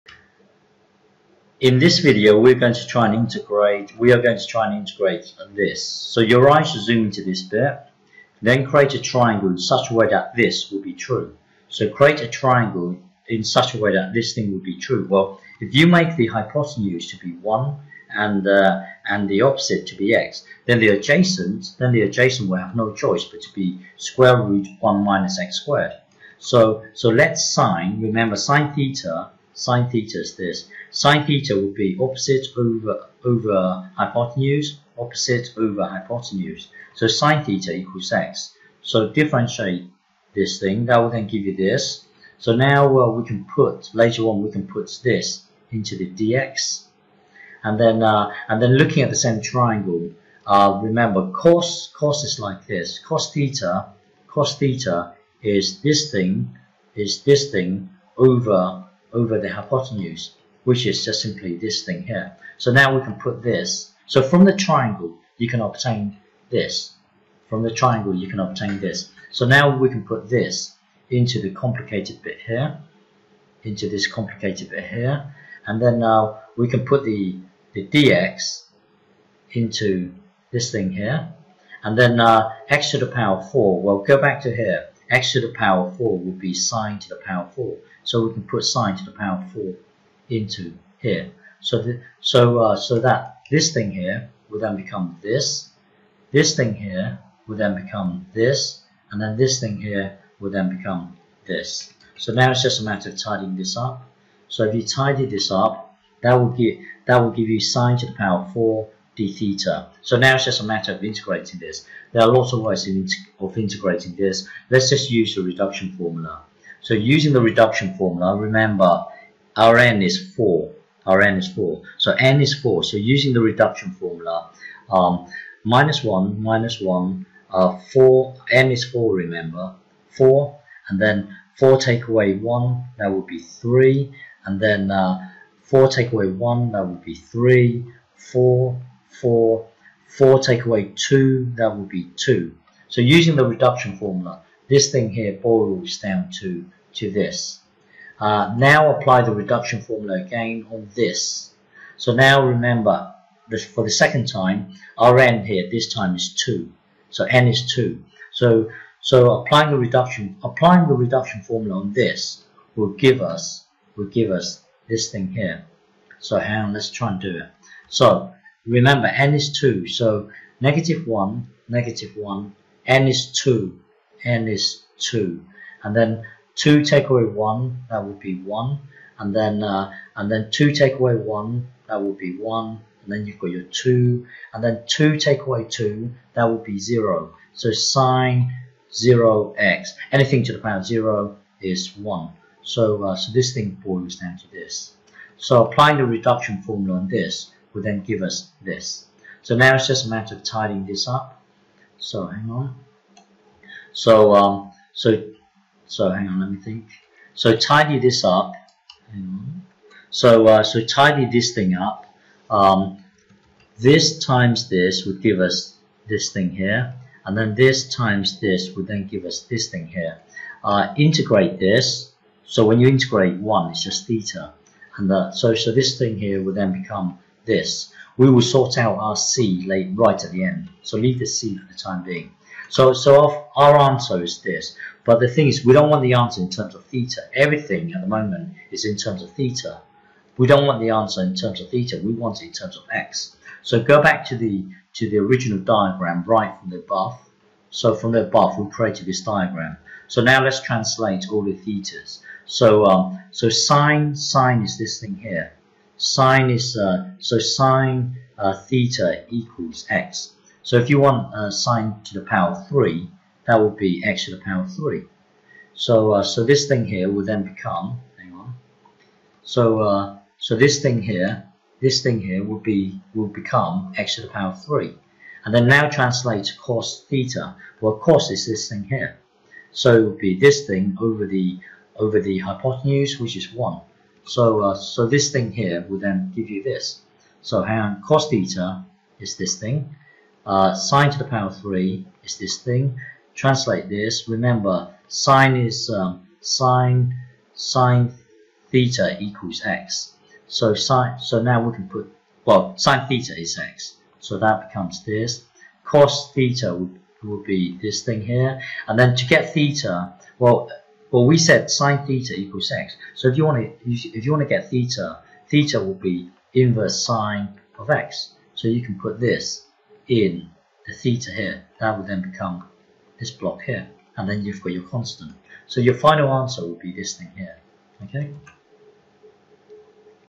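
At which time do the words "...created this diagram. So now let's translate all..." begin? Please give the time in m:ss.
4:08.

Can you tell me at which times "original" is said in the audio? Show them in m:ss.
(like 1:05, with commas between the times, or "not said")
4:05.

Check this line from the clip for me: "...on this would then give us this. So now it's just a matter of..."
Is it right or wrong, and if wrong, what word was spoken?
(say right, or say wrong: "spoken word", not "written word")
right.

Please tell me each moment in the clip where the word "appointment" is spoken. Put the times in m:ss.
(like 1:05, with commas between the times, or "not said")
not said.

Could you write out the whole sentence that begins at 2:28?
Uh, now apply the reduction formula again on this.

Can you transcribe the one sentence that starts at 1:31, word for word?
So, the, so, uh, so that this thing here will then become this.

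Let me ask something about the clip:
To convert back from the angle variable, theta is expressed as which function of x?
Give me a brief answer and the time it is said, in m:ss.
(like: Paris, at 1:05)
inverse sine, at 5:16.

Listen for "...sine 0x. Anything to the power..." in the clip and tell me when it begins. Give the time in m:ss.
3:07.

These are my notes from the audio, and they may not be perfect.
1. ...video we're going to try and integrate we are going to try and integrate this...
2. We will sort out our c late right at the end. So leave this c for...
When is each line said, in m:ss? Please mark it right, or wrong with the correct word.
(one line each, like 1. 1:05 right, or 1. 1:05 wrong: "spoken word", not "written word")
1. 0:01 right
2. 3:48 right.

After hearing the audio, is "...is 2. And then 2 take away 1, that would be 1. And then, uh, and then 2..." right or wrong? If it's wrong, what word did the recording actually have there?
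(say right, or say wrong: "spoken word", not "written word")
right.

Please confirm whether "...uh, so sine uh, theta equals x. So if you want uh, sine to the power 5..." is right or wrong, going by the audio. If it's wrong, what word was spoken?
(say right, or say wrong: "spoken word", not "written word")
wrong: "3", not "5".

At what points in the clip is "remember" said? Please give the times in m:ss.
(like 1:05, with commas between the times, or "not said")
0:28, 0:50, 1:58, 2:09, 2:32, 2:48, 4:54.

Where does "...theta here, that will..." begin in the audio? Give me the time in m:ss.
5:20.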